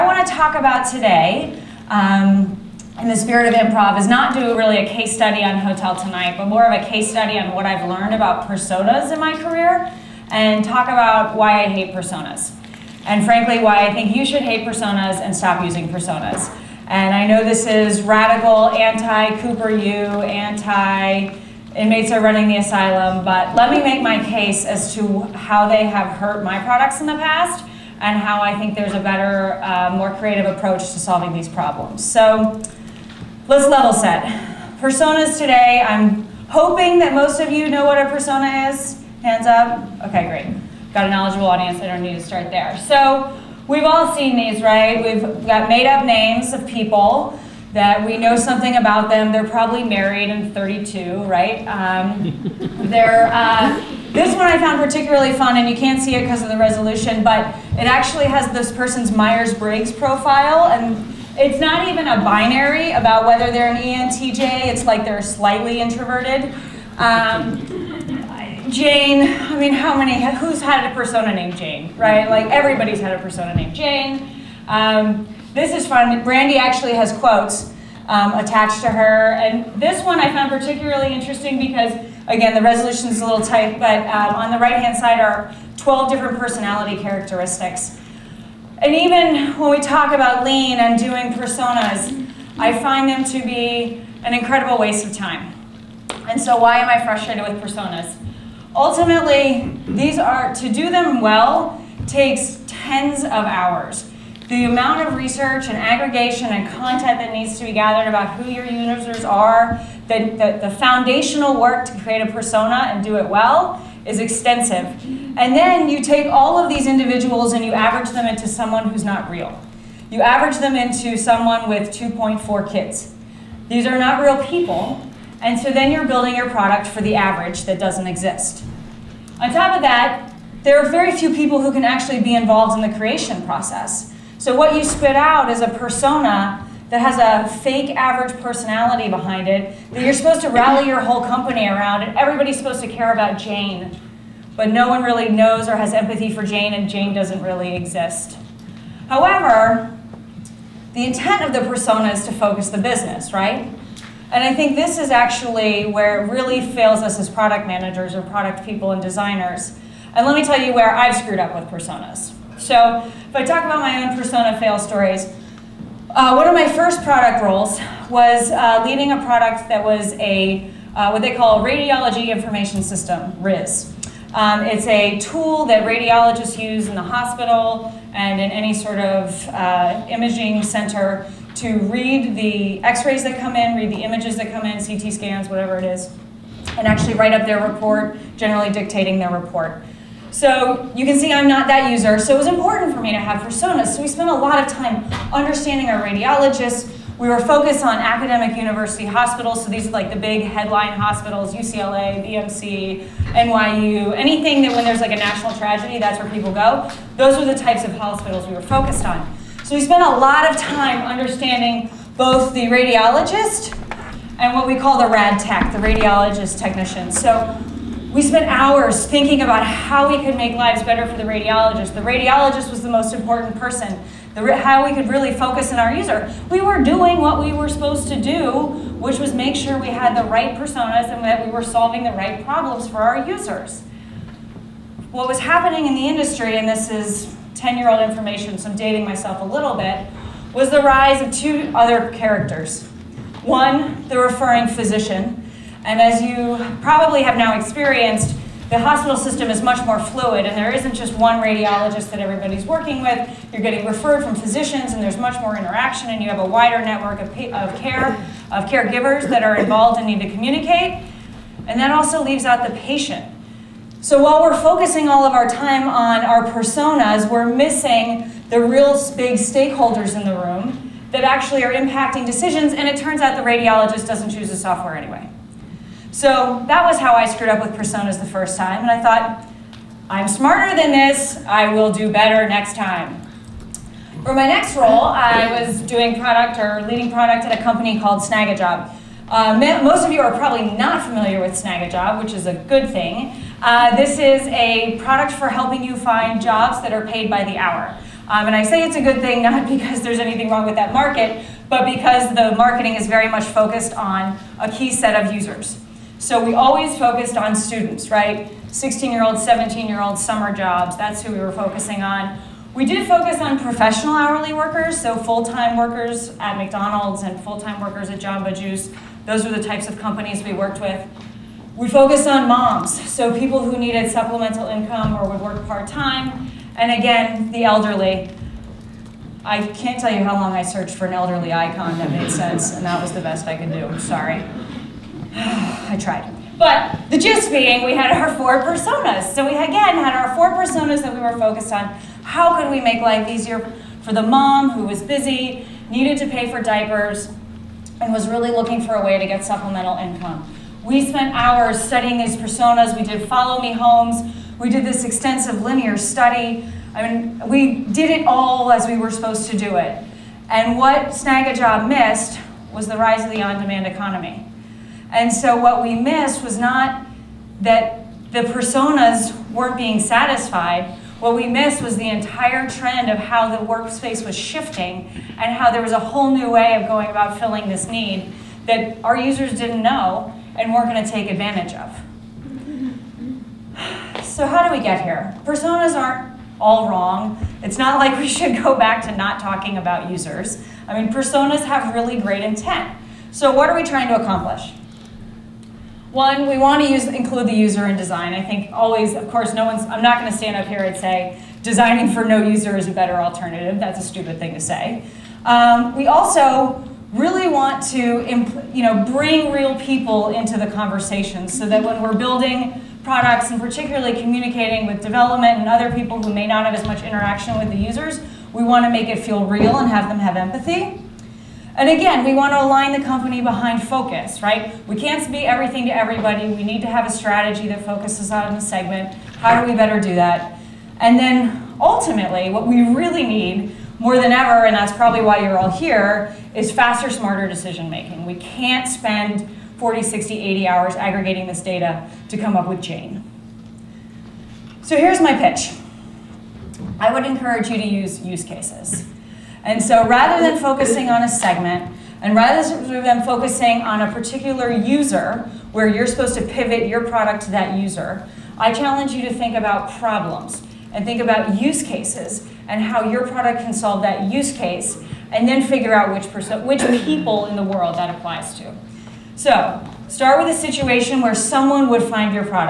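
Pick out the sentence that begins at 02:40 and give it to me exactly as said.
And let me tell you where I've screwed up with personas.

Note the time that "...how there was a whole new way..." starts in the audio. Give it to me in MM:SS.
06:15.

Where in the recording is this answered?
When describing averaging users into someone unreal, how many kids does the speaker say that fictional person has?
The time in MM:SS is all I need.
02:01.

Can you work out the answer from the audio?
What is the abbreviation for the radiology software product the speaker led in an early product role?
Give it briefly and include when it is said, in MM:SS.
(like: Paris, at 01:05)
RIS, at 02:53.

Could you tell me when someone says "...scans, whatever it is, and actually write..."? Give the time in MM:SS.
03:05.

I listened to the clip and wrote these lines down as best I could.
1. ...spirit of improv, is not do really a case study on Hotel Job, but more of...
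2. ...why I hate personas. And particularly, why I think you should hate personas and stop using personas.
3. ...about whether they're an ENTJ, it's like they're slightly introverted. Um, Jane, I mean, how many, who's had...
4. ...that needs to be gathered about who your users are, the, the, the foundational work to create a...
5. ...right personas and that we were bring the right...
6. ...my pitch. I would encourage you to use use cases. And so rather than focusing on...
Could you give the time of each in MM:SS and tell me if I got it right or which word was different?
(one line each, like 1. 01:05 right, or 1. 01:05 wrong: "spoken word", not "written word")
1. 00:03 wrong: "Tonight", not "Job"
2. 00:11 wrong: "frankly", not "particularly"
3. 01:02 right
4. 01:47 right
5. 03:50 wrong: "solving", not "bring"
6. 07:25 right.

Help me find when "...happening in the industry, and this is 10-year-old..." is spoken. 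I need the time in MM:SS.
03:55.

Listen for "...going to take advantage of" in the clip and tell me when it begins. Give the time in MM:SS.
06:20.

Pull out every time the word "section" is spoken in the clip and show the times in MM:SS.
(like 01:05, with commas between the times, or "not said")
not said.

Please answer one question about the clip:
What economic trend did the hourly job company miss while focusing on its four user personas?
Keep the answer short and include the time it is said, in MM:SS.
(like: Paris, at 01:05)
on-demand economy, at 06:03.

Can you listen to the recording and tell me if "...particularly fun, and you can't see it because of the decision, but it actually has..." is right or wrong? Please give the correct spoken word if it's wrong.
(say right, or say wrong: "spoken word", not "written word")
wrong: "resolution", not "decision".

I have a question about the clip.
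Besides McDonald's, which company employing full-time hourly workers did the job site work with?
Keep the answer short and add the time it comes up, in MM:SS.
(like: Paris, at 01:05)
Jamba Juice, at 05:18.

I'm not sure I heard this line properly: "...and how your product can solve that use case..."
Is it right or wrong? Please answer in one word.
right.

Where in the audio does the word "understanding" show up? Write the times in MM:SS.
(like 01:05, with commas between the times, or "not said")
03:15, 03:31.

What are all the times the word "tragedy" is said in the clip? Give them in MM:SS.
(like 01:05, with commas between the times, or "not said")
03:25.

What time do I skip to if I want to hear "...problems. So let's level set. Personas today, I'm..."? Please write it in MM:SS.
00:31.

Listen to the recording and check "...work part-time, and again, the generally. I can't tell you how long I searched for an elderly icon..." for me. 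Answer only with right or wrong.
wrong.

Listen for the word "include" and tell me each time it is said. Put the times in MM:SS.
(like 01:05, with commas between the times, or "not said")
06:37.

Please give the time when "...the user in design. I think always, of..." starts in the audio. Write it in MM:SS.
06:37.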